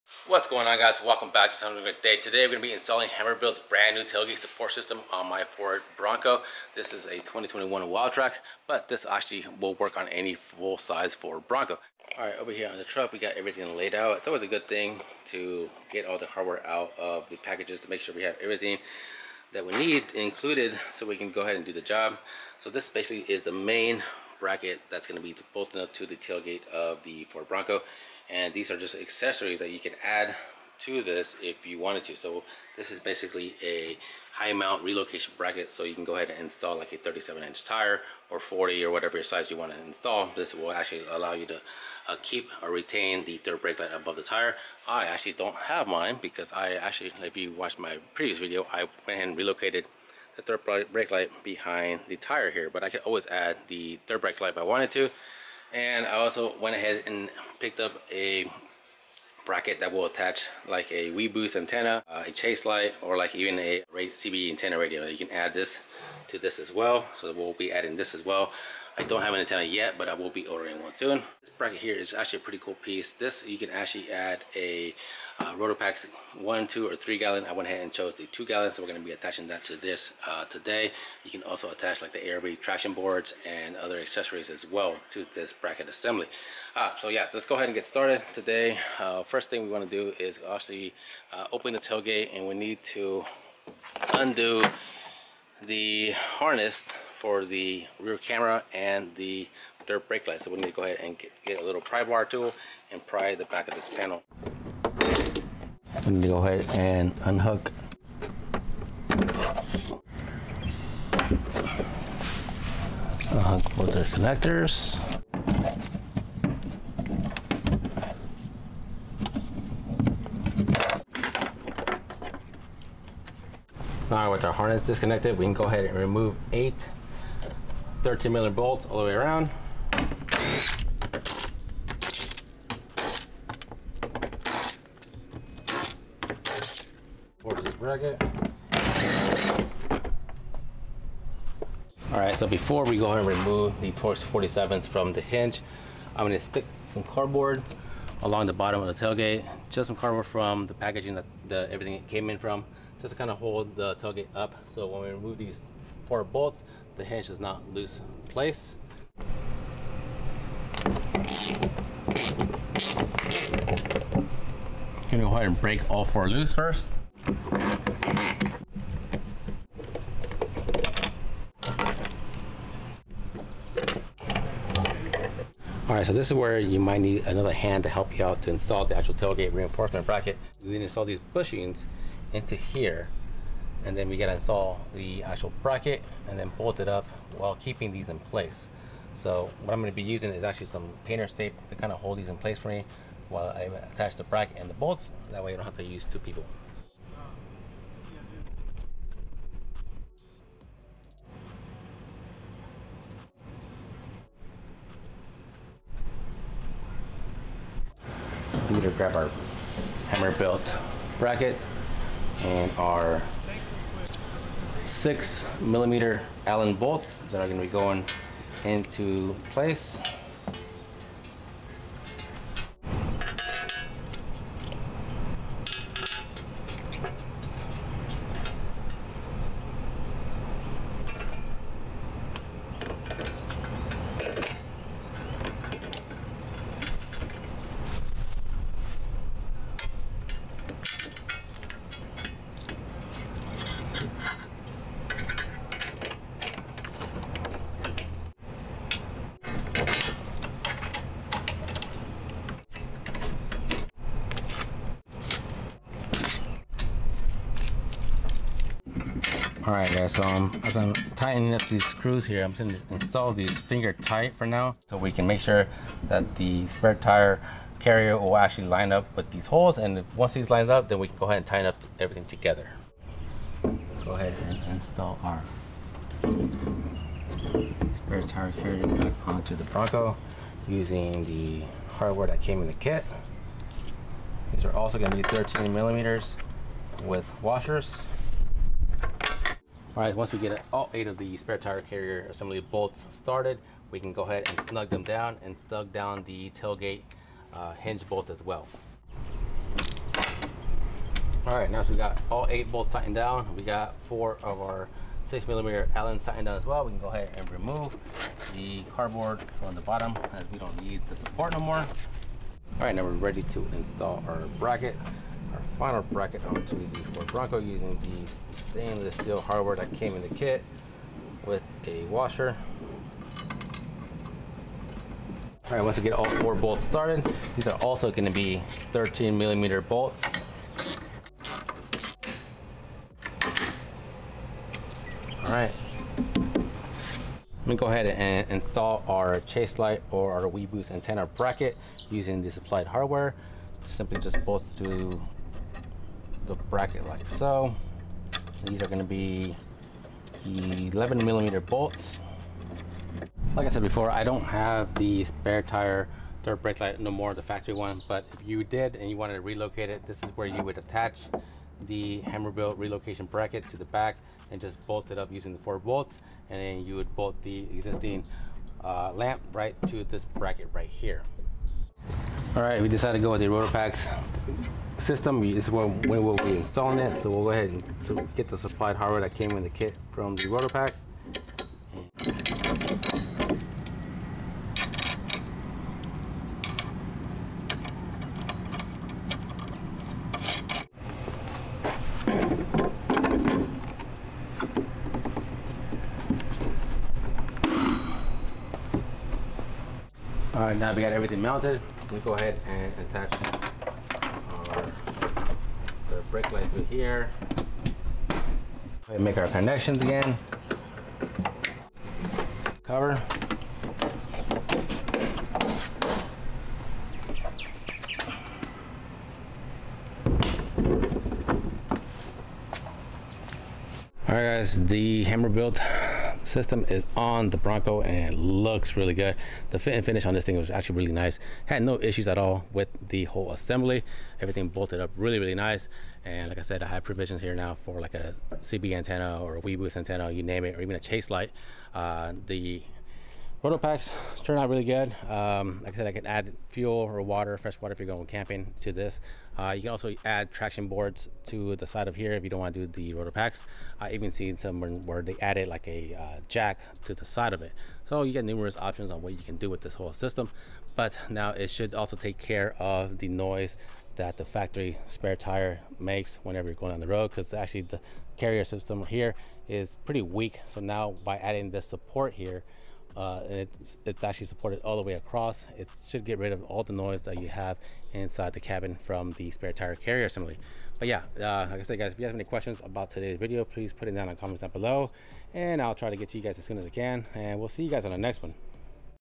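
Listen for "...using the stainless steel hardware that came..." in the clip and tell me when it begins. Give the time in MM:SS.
05:17.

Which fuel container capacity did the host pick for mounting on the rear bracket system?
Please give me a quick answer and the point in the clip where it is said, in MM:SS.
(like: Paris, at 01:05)
2 gallon, at 01:18.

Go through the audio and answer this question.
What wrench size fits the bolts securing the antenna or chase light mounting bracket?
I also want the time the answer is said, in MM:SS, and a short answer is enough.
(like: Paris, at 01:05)
11 millimeter, at 05:50.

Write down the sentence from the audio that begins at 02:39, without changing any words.
I'm gonna go ahead and break all four loose first.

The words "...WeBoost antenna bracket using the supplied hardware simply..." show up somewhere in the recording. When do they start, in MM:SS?
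05:40.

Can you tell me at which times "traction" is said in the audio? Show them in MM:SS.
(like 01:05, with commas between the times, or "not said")
01:22, 07:30.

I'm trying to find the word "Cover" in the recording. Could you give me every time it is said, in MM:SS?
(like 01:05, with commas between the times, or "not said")
06:52.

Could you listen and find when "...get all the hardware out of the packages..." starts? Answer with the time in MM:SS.
00:15.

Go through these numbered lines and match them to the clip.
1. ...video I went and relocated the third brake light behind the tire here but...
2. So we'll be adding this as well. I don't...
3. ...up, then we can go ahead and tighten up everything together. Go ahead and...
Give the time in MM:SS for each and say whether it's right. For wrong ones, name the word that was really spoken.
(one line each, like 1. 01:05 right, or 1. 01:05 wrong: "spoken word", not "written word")
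1. 00:48 right
2. 01:07 right
3. 04:30 right.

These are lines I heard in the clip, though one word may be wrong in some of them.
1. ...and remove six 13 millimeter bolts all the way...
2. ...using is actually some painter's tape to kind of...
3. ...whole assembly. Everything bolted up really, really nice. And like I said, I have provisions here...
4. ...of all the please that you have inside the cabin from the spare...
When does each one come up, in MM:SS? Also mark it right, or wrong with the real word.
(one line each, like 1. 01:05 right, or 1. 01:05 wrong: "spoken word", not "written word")
1. 02:05 wrong: "eight", not "six"
2. 03:10 right
3. 07:13 right
4. 07:56 wrong: "noise", not "please".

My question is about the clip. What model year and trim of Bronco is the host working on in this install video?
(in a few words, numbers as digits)
2021 Wildtrak.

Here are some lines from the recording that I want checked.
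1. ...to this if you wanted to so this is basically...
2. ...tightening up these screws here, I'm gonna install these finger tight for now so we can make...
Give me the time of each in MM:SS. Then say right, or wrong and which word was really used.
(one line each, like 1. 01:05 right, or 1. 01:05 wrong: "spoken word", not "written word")
1. 00:30 right
2. 04:20 right.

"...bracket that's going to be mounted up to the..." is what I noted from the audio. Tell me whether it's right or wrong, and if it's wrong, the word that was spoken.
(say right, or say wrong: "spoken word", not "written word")
wrong: "bolted", not "mounted".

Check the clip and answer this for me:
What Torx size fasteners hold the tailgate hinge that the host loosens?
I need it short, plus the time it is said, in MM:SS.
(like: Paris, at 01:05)
Torx 47, at 02:23.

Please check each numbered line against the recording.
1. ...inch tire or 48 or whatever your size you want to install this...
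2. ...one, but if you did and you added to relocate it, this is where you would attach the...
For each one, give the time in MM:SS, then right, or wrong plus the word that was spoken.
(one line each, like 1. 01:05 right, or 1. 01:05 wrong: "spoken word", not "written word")
1. 00:37 wrong: "40", not "48"
2. 05:57 wrong: "wanted", not "added".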